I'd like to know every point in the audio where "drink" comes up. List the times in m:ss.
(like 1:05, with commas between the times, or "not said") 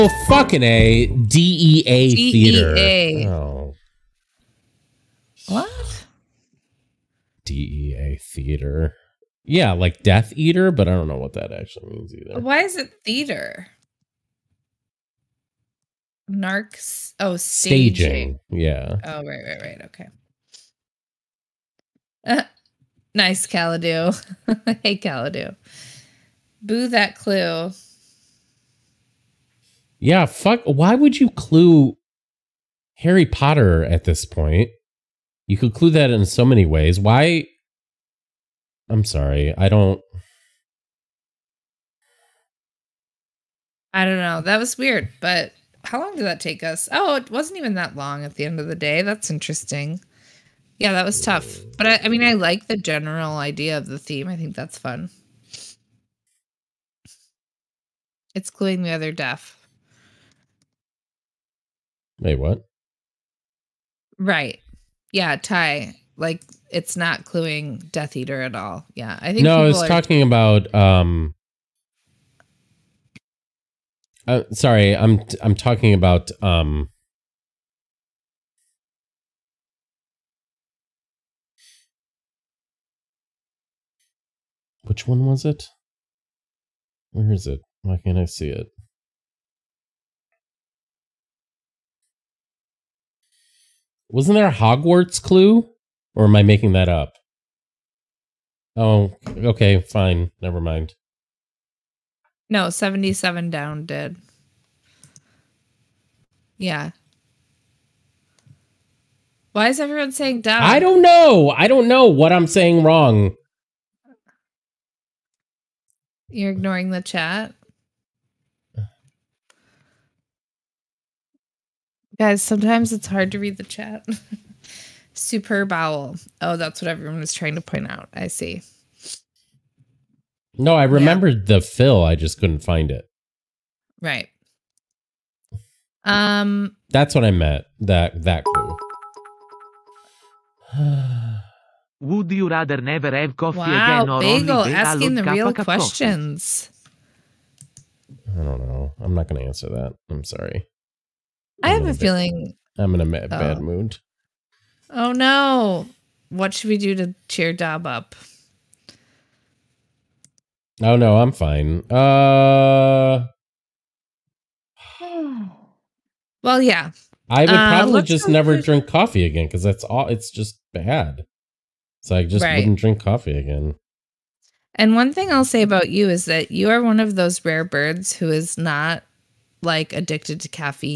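2:48, 2:52.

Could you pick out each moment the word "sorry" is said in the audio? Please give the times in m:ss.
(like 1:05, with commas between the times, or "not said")
0:39, 1:14, 2:30.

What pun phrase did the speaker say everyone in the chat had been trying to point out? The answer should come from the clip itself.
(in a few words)
Superb owl.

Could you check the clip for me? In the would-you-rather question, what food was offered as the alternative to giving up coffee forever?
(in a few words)
bagel.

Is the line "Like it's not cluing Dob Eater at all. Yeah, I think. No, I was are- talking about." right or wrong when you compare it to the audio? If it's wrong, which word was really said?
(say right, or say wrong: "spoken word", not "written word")
wrong: "Death", not "Dob".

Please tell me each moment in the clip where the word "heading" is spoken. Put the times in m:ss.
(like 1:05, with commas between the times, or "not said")
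not said.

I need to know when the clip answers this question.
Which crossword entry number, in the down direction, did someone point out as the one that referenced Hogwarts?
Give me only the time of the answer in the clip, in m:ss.
1:42.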